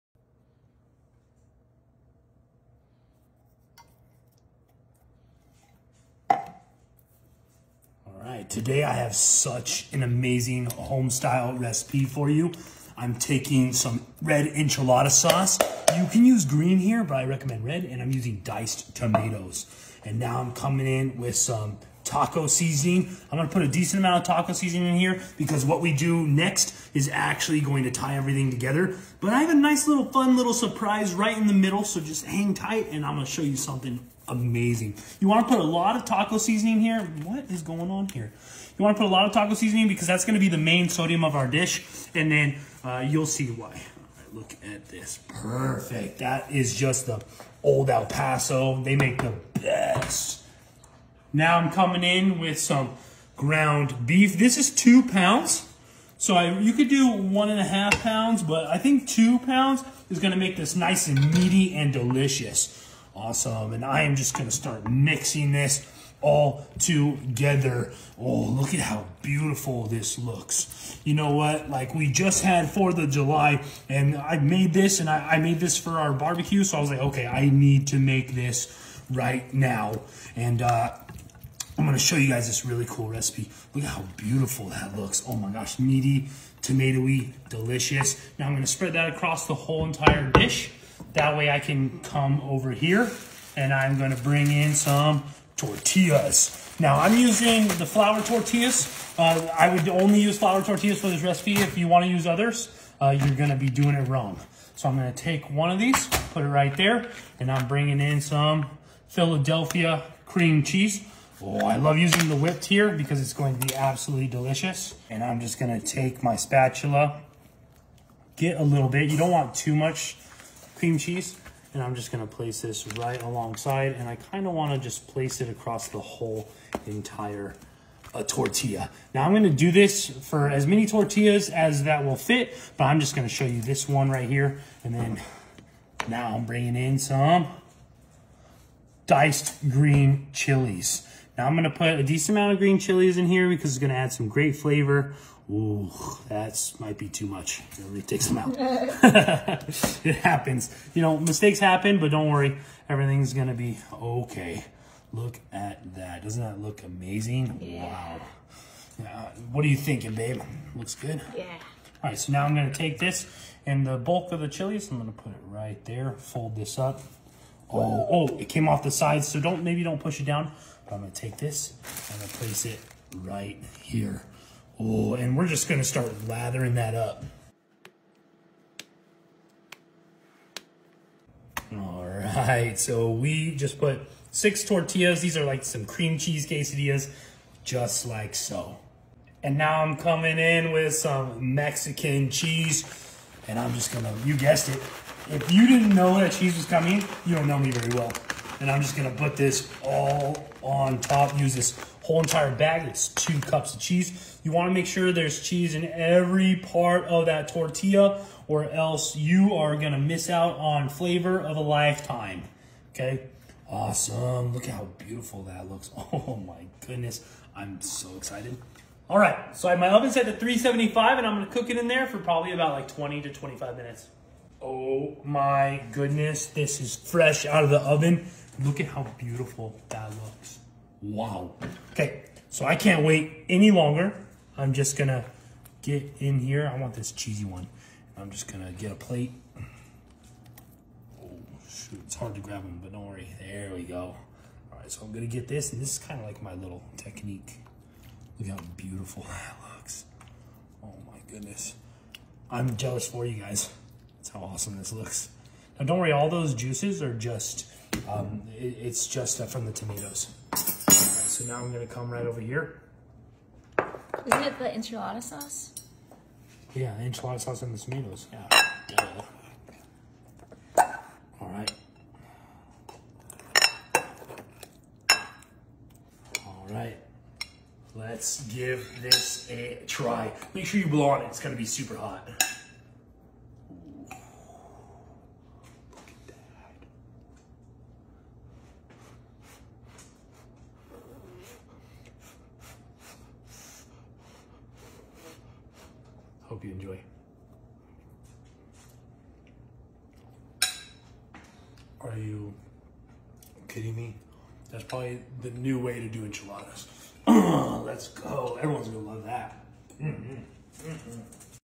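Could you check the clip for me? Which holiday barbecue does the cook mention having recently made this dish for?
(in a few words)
4th of July.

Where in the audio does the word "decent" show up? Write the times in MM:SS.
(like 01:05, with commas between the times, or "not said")
00:23, 02:22.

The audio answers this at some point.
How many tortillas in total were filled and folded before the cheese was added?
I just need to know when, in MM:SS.
03:04.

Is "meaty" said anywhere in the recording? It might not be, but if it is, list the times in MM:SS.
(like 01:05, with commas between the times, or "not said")
01:01, 01:25.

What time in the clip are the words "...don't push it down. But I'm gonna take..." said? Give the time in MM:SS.
02:49.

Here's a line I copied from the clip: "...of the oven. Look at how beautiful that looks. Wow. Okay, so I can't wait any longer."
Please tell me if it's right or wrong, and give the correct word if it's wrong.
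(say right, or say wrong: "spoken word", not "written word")
right.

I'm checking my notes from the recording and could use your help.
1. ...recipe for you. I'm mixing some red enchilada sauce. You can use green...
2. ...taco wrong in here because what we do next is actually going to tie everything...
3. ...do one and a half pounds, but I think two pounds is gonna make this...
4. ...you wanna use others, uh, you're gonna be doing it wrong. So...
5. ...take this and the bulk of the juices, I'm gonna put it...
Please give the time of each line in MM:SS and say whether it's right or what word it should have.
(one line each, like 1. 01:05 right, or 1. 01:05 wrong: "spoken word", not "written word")
1. 00:11 wrong: "taking", not "mixing"
2. 00:24 wrong: "seasoning", not "wrong"
3. 00:56 right
4. 01:41 right
5. 02:42 wrong: "chilies", not "juices".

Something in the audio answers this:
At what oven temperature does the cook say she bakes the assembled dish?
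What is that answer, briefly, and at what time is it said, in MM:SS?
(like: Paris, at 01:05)
375, at 03:40.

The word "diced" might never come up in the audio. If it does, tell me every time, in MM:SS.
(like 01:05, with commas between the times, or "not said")
00:18, 02:19.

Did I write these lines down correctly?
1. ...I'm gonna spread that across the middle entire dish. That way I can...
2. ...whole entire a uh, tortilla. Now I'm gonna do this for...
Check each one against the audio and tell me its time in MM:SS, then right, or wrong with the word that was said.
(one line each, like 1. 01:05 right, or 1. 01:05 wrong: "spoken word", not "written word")
1. 01:28 wrong: "whole", not "middle"
2. 02:05 right.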